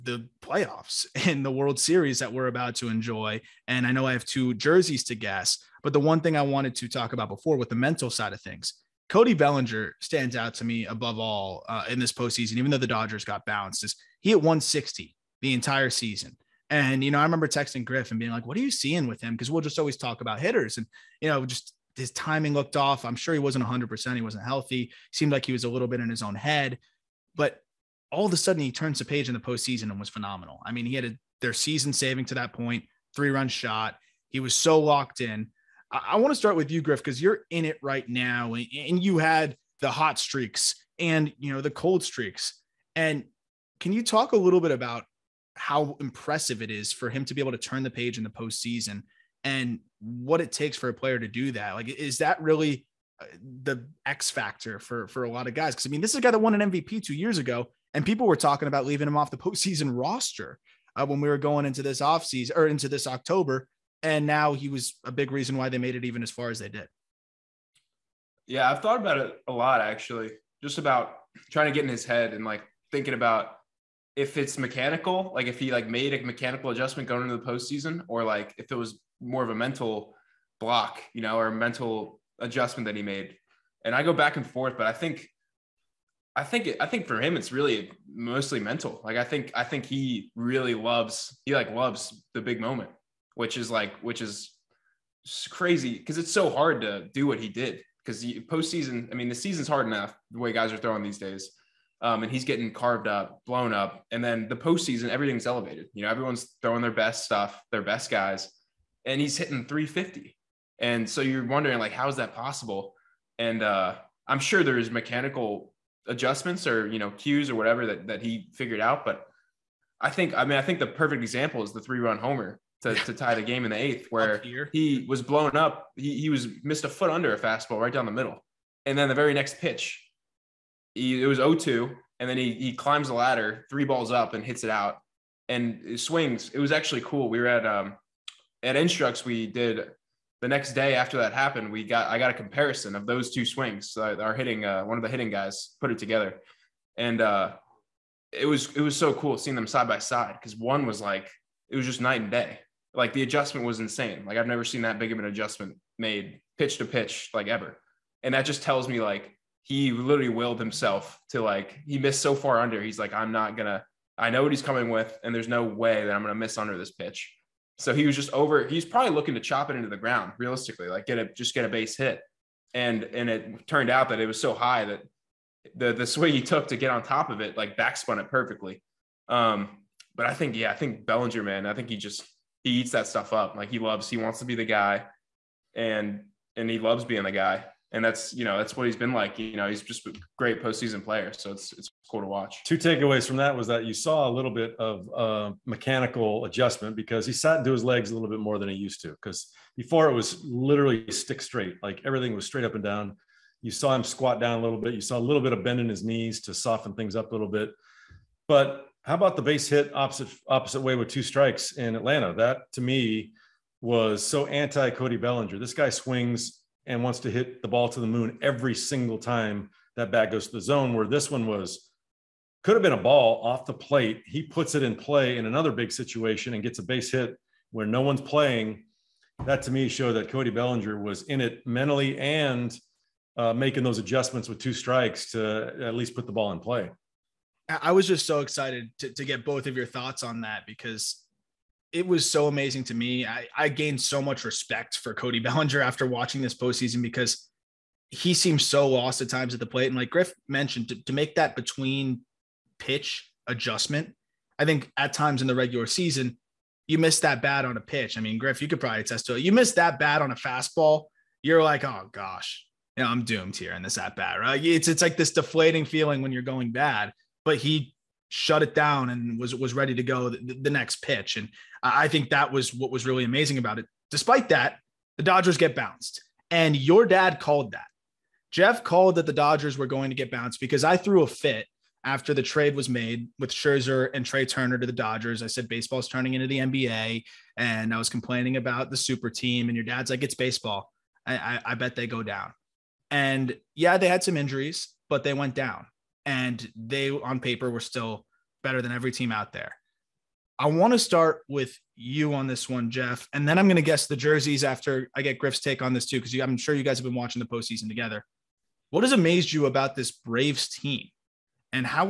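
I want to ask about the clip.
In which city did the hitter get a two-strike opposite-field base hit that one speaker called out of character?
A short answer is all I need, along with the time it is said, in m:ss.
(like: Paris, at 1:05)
Atlanta, at 3:31.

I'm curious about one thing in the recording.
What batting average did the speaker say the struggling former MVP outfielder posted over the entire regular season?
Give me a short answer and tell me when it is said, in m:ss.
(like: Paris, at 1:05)
160, at 0:14.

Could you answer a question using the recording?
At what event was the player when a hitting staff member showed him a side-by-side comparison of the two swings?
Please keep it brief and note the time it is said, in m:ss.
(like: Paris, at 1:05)
Instructs, at 2:18.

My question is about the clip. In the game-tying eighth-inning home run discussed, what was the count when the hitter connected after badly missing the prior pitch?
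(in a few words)
0-2.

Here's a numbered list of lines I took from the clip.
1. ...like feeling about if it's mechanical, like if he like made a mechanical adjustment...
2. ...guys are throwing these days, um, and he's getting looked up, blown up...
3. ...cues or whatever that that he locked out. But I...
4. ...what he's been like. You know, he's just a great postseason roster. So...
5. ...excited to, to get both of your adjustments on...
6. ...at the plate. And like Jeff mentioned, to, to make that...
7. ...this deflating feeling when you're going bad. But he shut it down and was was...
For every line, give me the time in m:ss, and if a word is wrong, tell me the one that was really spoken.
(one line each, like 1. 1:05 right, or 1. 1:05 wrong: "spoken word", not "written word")
1. 1:12 wrong: "thinking", not "feeling"
2. 1:40 wrong: "carved", not "looked"
3. 1:57 wrong: "figured", not "locked"
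4. 3:08 wrong: "player", not "roster"
5. 3:58 wrong: "thoughts", not "adjustments"
6. 4:09 wrong: "Griff", not "Jeff"
7. 4:25 right.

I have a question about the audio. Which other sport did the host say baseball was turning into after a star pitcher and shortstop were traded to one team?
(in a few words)
NBA.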